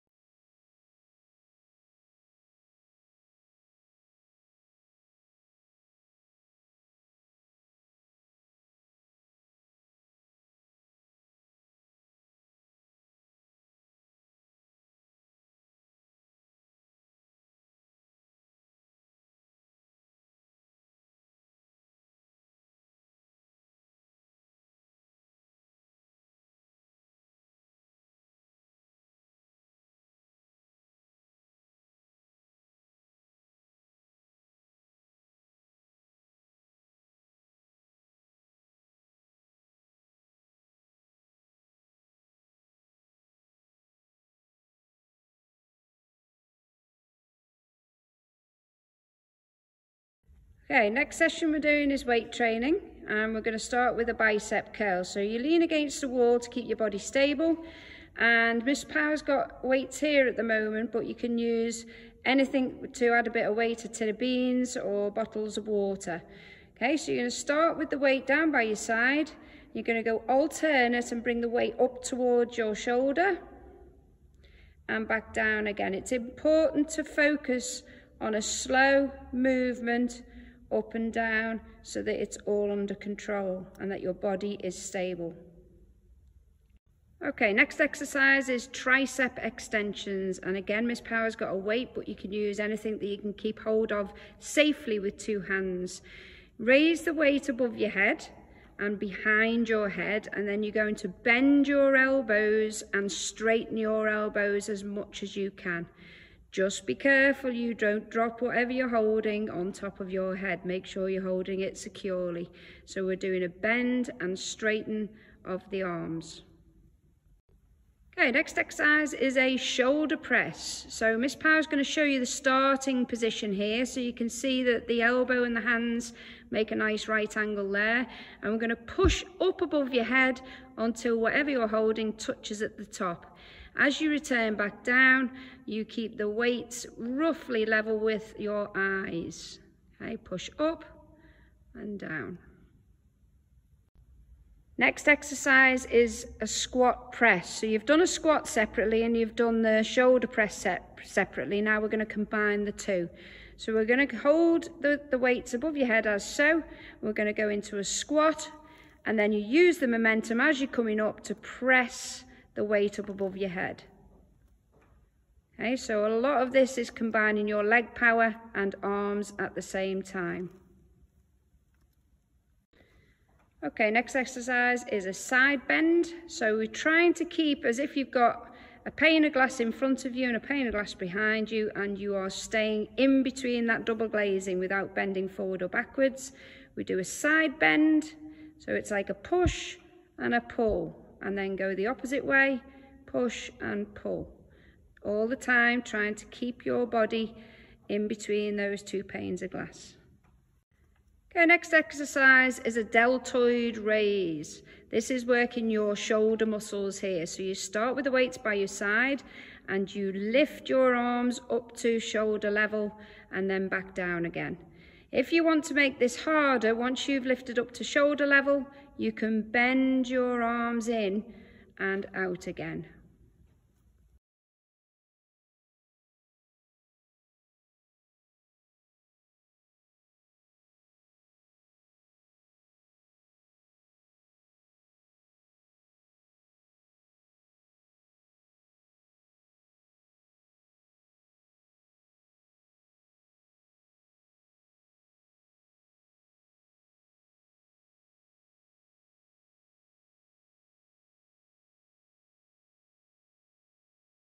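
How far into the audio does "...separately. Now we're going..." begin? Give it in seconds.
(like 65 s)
151 s.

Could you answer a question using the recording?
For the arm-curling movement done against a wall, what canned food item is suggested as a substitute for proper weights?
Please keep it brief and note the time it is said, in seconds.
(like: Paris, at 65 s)
A tin of beans, at 63 s.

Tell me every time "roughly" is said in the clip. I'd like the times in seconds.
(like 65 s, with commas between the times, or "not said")
136 s.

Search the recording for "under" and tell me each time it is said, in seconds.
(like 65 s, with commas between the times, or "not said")
82 s.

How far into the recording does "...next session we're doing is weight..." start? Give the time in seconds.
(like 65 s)
50 s.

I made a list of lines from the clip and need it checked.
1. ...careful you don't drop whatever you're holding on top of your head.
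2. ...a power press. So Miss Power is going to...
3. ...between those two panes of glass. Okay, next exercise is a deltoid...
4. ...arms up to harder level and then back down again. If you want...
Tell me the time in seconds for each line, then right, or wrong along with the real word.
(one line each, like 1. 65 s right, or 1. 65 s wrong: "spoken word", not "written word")
1. 106 s right
2. 119 s wrong: "shoulder", not "power"
3. 198 s right
4. 210 s wrong: "shoulder", not "harder".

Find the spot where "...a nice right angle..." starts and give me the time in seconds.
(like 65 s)
126 s.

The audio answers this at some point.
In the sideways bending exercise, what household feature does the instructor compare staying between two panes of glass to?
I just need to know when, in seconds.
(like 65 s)
183 s.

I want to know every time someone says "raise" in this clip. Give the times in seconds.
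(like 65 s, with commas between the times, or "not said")
96 s, 203 s.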